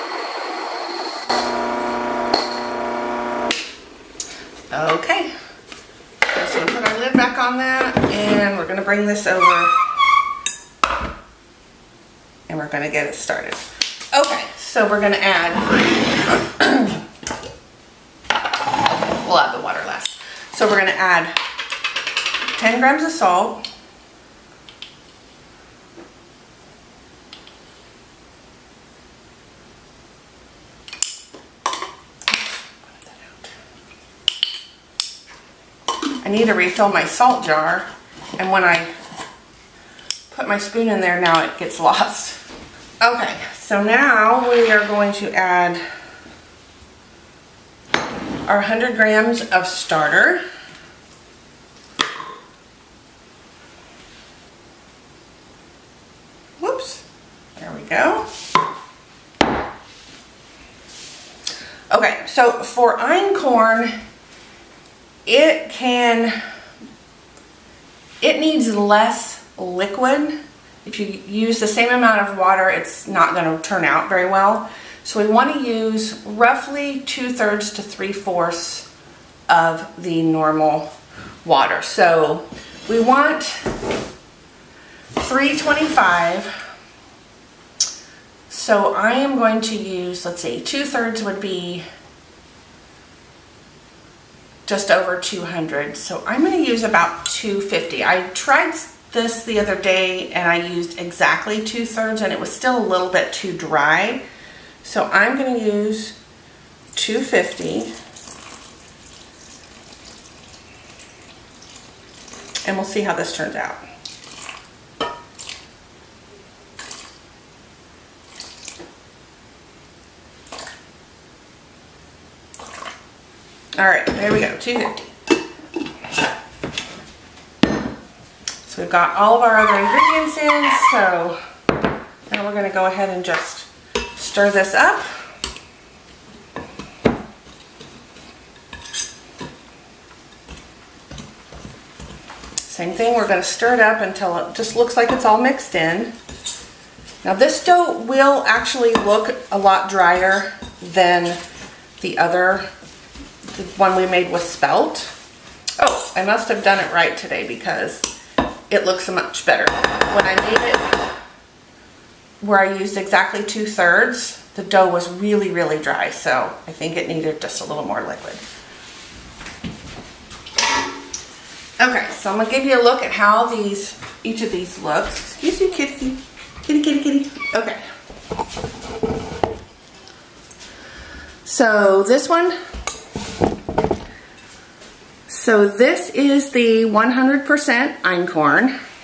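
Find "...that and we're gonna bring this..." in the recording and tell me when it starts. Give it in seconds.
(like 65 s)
7 s.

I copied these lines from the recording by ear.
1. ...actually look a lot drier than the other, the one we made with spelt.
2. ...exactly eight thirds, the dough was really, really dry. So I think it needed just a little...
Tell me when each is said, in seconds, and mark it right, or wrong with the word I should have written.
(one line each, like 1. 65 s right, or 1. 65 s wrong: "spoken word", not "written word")
1. 148 s right
2. 162 s wrong: "two", not "eight".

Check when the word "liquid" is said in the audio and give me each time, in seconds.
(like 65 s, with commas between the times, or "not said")
69 s, 168 s.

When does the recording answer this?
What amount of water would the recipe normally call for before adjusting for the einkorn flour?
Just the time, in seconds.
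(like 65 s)
83 s.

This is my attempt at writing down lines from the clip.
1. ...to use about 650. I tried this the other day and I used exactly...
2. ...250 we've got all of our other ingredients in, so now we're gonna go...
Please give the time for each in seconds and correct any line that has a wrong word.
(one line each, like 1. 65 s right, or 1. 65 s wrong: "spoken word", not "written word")
1. 96 s wrong: "250", not "650"
2. 124 s right.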